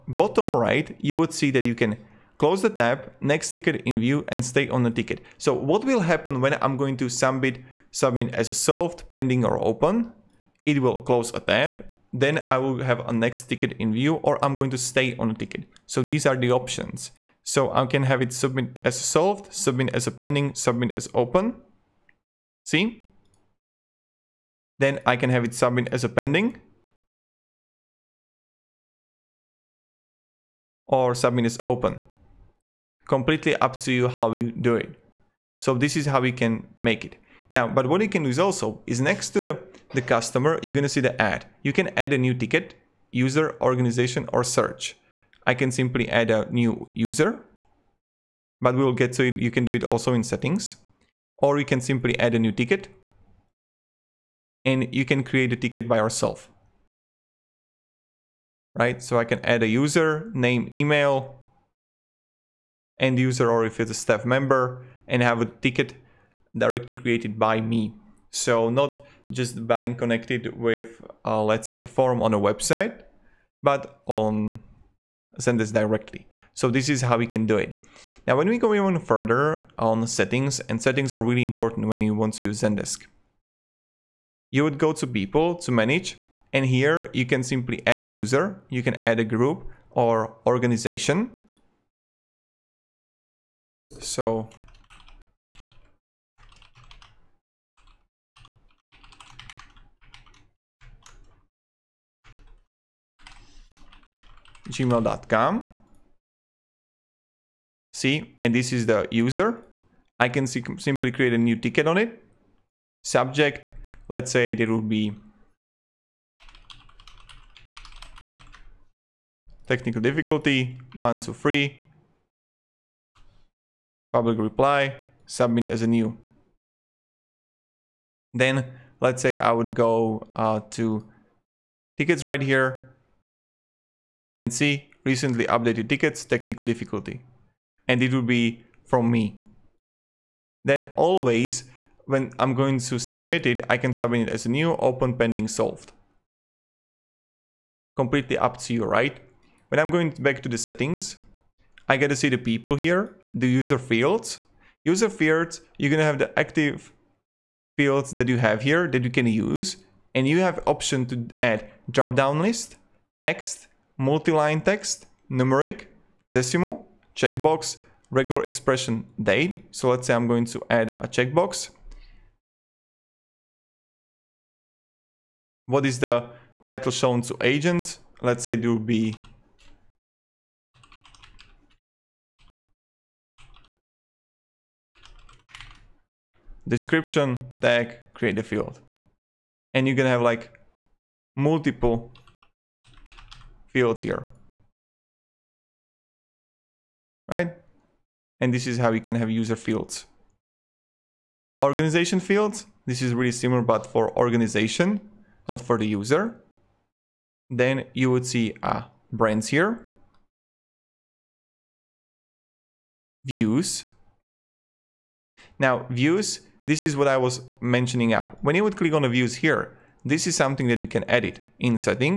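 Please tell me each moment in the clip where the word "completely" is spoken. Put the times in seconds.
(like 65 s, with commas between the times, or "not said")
33 s, 147 s.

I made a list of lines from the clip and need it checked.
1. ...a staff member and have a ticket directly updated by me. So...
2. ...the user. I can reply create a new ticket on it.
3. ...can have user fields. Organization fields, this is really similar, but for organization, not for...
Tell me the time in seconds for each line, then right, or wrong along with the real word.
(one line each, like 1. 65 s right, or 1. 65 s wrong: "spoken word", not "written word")
1. 63 s wrong: "created", not "updated"
2. 108 s wrong: "simply", not "reply"
3. 199 s right.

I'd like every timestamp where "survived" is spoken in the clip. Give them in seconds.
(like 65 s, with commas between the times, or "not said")
not said.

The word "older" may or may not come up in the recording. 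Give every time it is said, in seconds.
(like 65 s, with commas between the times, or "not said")
not said.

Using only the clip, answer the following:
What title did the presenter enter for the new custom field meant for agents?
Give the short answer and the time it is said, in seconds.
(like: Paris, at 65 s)
Description tag, at 186 s.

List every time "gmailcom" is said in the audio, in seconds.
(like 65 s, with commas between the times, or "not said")
104 s.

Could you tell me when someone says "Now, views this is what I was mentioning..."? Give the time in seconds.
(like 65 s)
215 s.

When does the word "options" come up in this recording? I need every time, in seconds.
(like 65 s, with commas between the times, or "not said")
16 s, 160 s.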